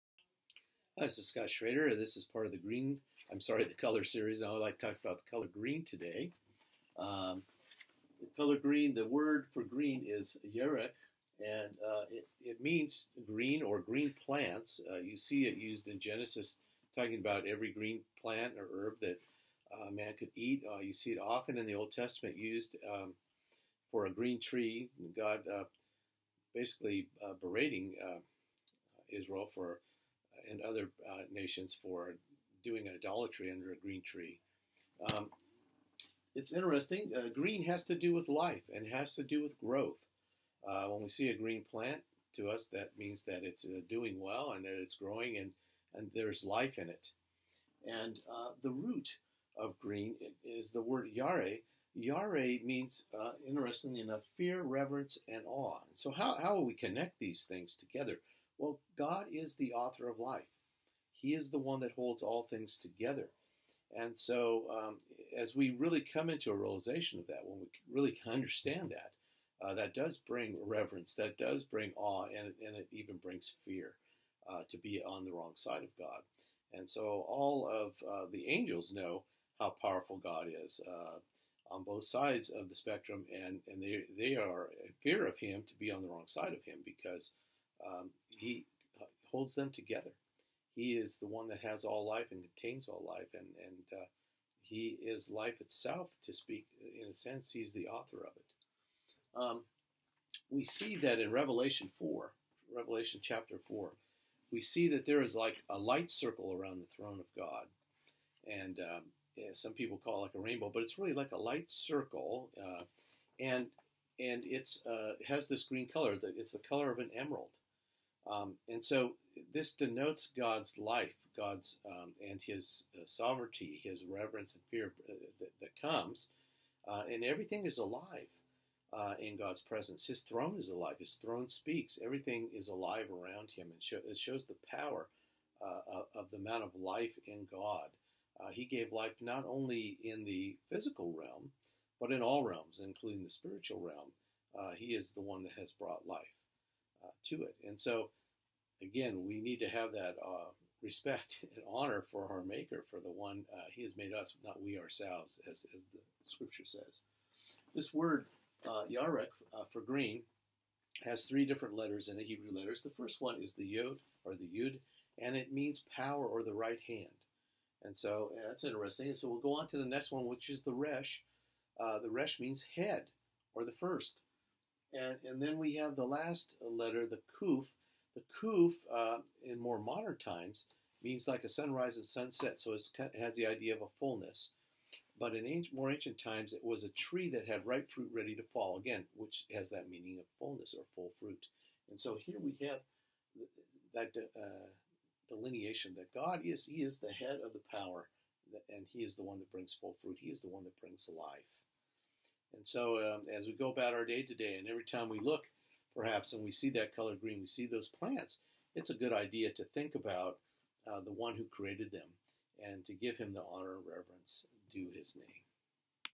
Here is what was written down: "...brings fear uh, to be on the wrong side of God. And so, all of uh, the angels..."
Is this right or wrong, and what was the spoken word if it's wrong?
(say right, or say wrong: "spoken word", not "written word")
right.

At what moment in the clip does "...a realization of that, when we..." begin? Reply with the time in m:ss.
1:06.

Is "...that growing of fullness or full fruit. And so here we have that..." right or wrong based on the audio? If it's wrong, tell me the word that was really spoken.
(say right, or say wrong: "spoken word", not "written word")
wrong: "meaning", not "growing".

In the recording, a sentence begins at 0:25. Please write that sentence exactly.
God uh, basically uh, berating Israel for and other uh, nations for doing idolatry under a green tree.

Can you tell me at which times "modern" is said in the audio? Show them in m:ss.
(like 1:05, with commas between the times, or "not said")
2:59.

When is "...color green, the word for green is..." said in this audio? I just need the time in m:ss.
0:08.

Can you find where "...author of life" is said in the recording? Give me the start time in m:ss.
0:59.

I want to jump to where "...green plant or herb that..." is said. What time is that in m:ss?
0:17.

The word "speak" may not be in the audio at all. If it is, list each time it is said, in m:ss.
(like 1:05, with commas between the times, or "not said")
1:36, 2:11.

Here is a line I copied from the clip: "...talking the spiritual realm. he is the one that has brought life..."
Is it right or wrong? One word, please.
wrong.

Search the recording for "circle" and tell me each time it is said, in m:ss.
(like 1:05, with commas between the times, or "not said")
1:46, 1:51.